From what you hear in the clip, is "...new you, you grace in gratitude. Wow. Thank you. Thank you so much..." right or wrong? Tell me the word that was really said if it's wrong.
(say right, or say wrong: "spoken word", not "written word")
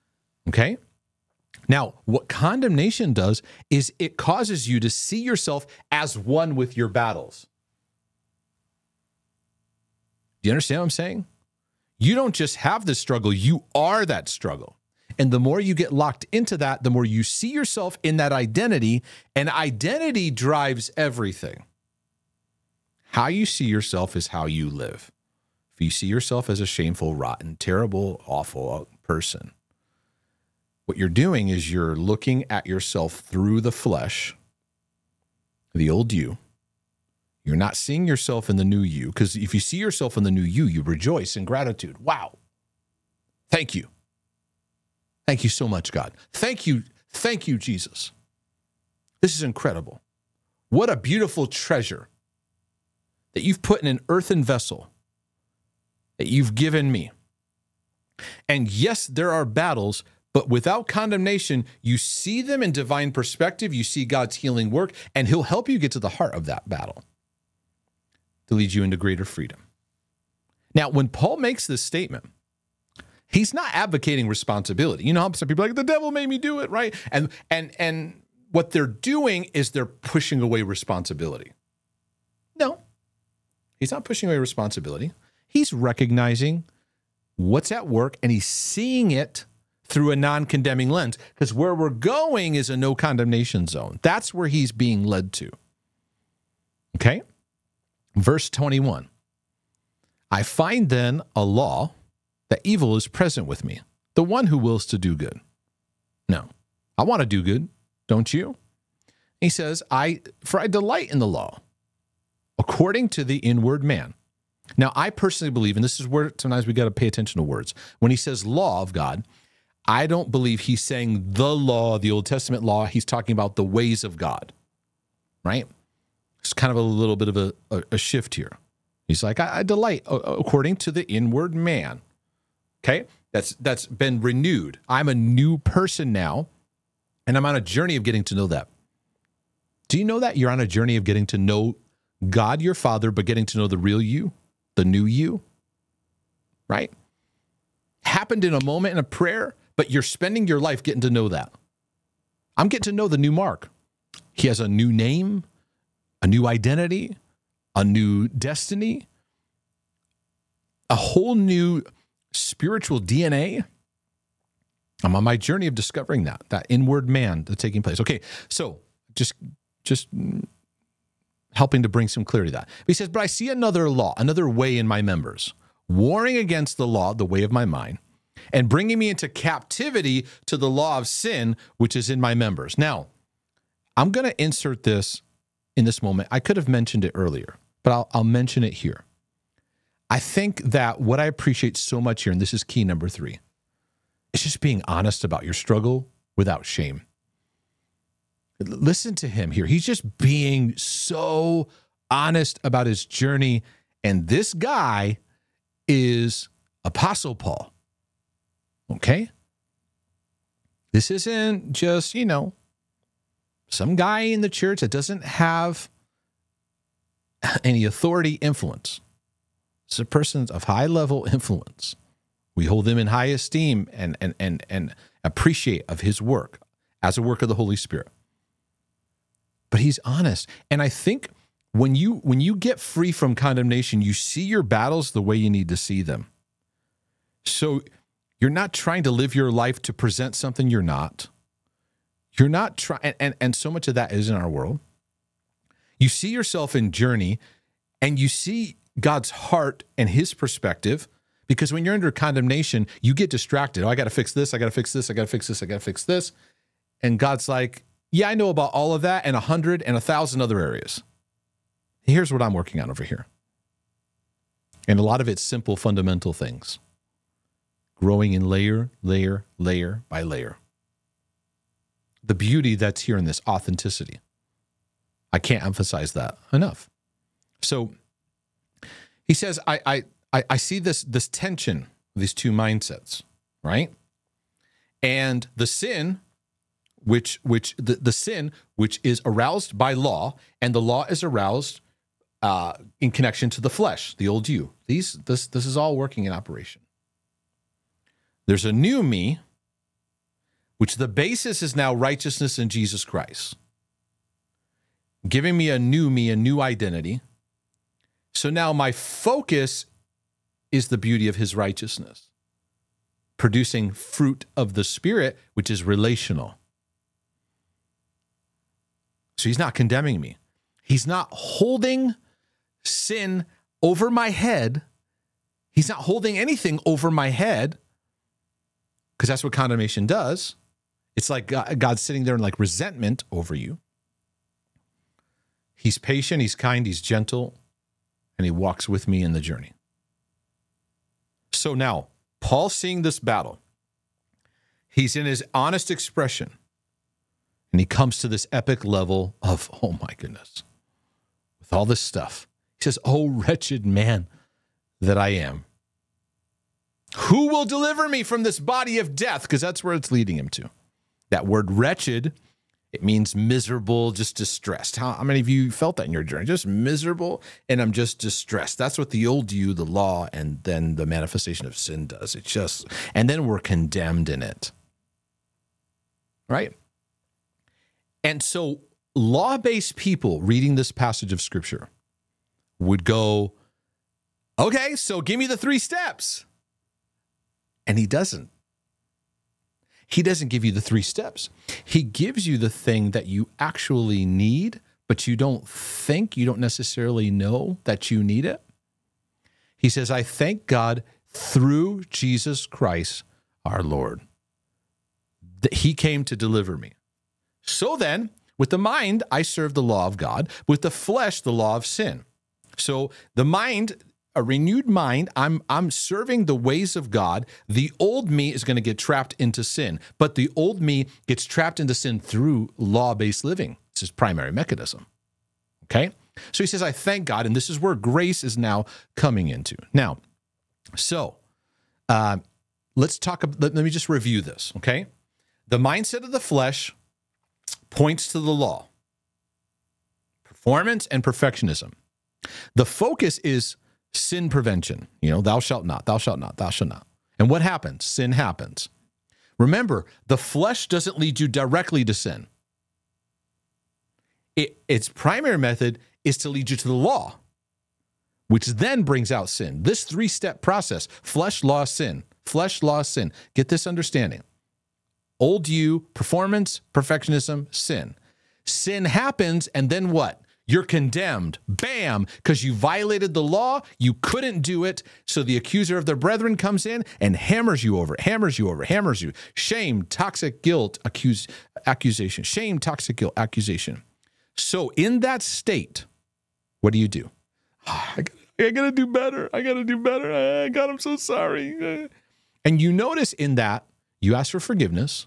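wrong: "rejoice", not "grace".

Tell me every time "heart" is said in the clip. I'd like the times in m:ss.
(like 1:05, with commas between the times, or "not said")
1:06, 4:09.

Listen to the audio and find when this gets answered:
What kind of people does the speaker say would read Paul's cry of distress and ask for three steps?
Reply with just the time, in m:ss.
6:19.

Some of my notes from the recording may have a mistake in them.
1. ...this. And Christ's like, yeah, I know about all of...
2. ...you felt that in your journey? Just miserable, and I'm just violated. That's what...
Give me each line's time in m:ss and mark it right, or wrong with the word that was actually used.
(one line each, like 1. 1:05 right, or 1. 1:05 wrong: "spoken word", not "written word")
1. 4:16 wrong: "God", not "Christ"
2. 6:05 wrong: "distressed", not "violated".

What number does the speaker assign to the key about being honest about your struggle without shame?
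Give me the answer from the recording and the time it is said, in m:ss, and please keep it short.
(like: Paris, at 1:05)
3, at 3:12.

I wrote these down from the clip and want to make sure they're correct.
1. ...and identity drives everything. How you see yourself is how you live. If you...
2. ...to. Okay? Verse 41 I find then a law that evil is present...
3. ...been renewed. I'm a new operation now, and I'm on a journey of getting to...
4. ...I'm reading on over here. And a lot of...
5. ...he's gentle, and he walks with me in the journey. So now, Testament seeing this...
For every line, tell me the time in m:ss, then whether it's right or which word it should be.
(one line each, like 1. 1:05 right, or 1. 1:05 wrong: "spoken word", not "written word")
1. 0:19 right
2. 1:35 wrong: "21", not "41"
3. 2:13 wrong: "person", not "operation"
4. 4:22 wrong: "working", not "reading"
5. 5:36 wrong: "Paul", not "Testament".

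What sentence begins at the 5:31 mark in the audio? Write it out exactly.
It's like God's sitting there in like resentment over you.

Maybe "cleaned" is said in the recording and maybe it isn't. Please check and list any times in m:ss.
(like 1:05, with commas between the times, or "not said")
not said.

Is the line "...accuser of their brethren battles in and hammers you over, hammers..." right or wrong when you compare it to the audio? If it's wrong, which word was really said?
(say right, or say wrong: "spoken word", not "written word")
wrong: "comes", not "battles".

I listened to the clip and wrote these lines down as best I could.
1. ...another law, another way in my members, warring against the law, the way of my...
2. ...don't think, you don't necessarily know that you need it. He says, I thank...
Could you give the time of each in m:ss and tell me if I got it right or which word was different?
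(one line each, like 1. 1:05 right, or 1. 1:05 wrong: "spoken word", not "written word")
1. 2:53 right
2. 6:35 right.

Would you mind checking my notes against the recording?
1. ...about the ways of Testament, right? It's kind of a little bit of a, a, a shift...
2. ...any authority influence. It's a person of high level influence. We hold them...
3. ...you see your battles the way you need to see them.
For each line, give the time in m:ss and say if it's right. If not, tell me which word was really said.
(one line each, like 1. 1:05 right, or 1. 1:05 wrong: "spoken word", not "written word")
1. 2:03 wrong: "God", not "Testament"
2. 3:37 right
3. 3:54 right.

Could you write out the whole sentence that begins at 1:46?
No, I want to do good, don't you?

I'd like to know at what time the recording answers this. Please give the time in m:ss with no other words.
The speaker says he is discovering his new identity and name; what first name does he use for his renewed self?
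2:33.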